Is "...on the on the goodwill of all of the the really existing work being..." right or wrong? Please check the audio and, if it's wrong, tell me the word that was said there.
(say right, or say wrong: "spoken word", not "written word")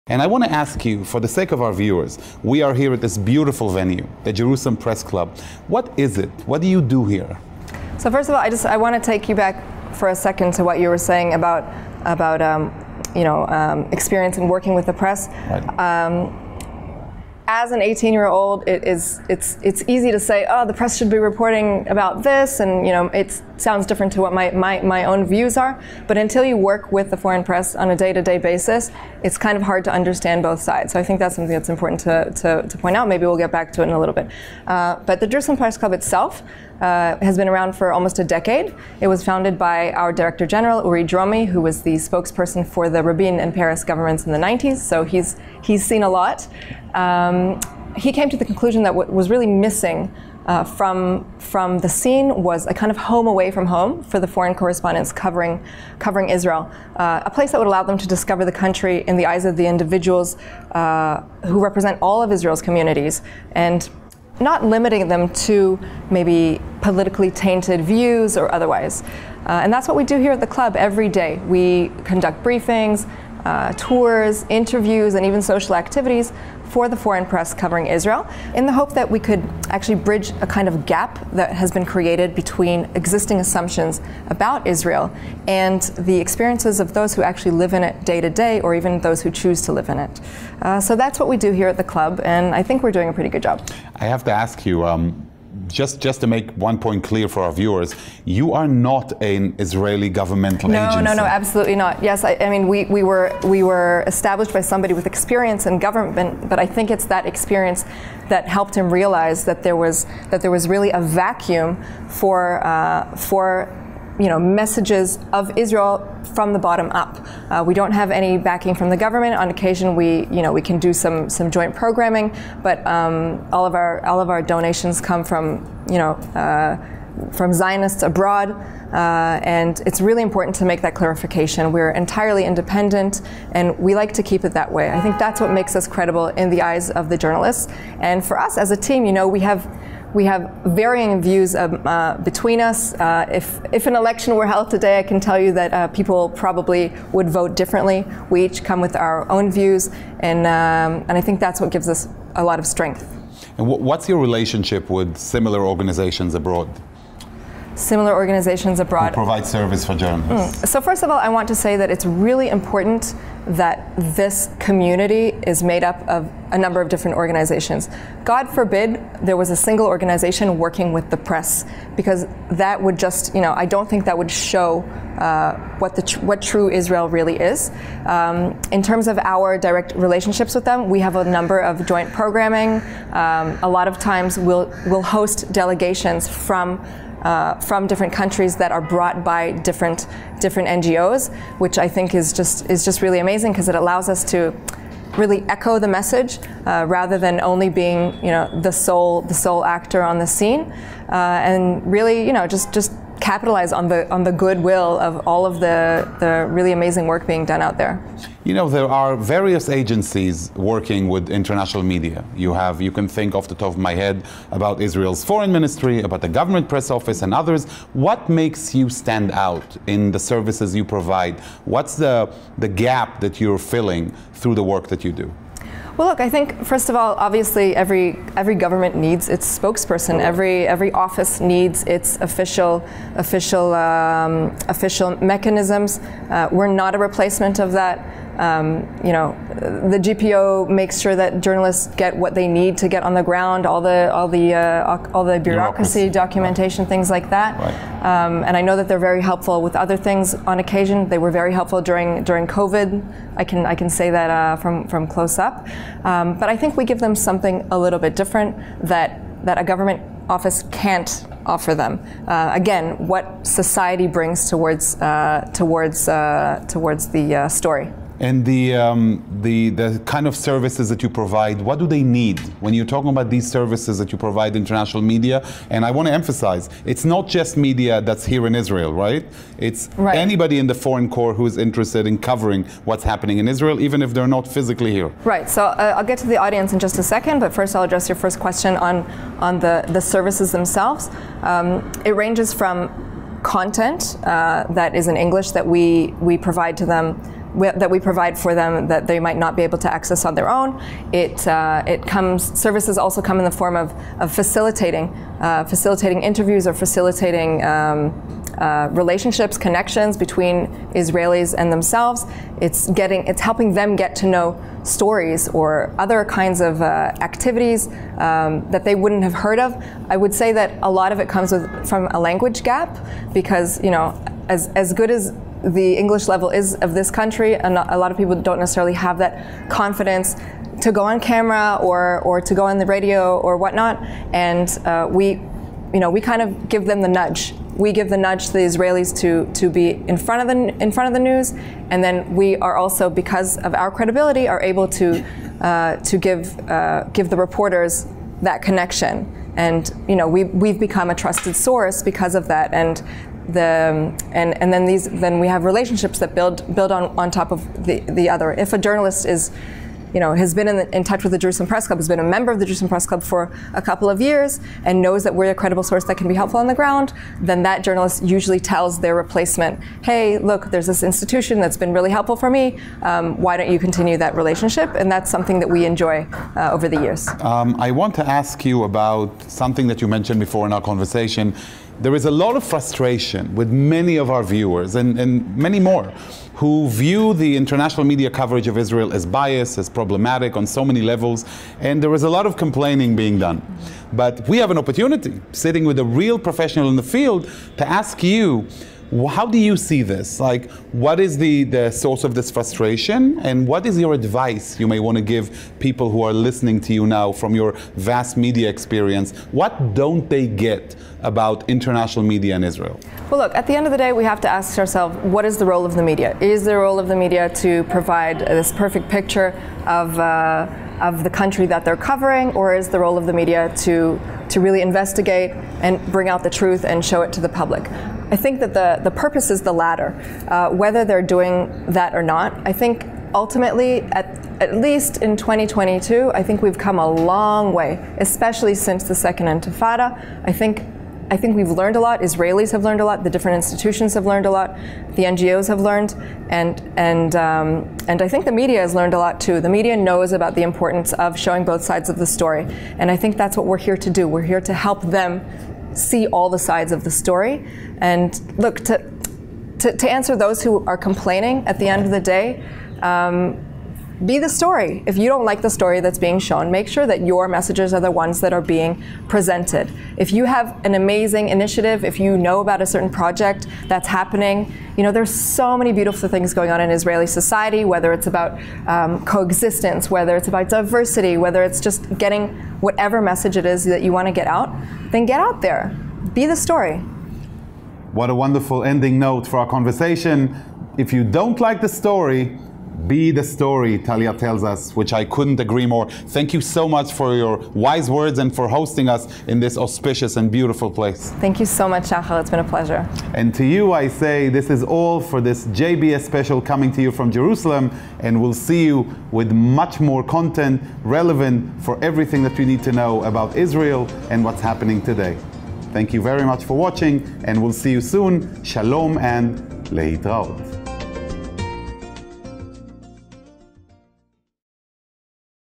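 wrong: "amazing", not "existing".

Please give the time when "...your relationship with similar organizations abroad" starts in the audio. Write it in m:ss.
2:34.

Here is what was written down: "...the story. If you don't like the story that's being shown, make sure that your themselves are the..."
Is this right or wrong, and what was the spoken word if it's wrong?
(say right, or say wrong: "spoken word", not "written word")
wrong: "messages", not "themselves".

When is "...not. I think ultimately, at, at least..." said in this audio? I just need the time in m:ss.
7:12.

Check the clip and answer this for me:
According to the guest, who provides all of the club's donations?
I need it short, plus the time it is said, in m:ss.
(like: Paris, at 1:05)
Zionists abroad, at 2:07.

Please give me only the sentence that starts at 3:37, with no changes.
What makes you stand out in the services you provide?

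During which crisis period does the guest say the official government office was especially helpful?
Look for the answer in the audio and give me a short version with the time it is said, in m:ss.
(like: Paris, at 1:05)
COVID, at 4:12.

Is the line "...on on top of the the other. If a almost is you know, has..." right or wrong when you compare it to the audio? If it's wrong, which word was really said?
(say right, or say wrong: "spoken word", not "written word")
wrong: "journalist", not "almost".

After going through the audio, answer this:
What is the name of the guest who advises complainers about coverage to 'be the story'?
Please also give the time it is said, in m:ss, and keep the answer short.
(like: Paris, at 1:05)
Talia, at 8:13.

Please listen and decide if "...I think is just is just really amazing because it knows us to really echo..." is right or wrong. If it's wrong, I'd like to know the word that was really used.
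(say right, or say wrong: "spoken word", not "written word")
wrong: "allows", not "knows".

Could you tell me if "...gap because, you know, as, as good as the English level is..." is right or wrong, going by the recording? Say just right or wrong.
right.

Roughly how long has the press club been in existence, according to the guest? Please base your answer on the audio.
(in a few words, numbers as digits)
almost a decade.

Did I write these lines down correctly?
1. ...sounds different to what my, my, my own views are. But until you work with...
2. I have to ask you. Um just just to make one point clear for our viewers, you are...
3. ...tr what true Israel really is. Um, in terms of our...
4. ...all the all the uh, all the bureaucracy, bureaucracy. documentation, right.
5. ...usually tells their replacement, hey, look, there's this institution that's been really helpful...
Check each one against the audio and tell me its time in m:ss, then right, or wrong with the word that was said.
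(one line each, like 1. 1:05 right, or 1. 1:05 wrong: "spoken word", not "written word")
1. 0:23 right
2. 1:33 right
3. 2:56 right
4. 4:03 right
5. 6:08 right.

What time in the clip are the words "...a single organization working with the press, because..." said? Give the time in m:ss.
2:49.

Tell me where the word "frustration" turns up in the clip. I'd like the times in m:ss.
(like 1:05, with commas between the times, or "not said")
6:22, 6:42.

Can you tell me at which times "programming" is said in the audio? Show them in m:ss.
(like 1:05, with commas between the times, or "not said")
2:01, 3:02.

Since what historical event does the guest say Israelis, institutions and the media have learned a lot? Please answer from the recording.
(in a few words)
Second Intifada.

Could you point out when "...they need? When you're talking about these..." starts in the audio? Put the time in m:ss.
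4:31.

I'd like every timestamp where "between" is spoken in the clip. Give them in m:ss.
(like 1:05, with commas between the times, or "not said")
1:22, 2:22, 5:10.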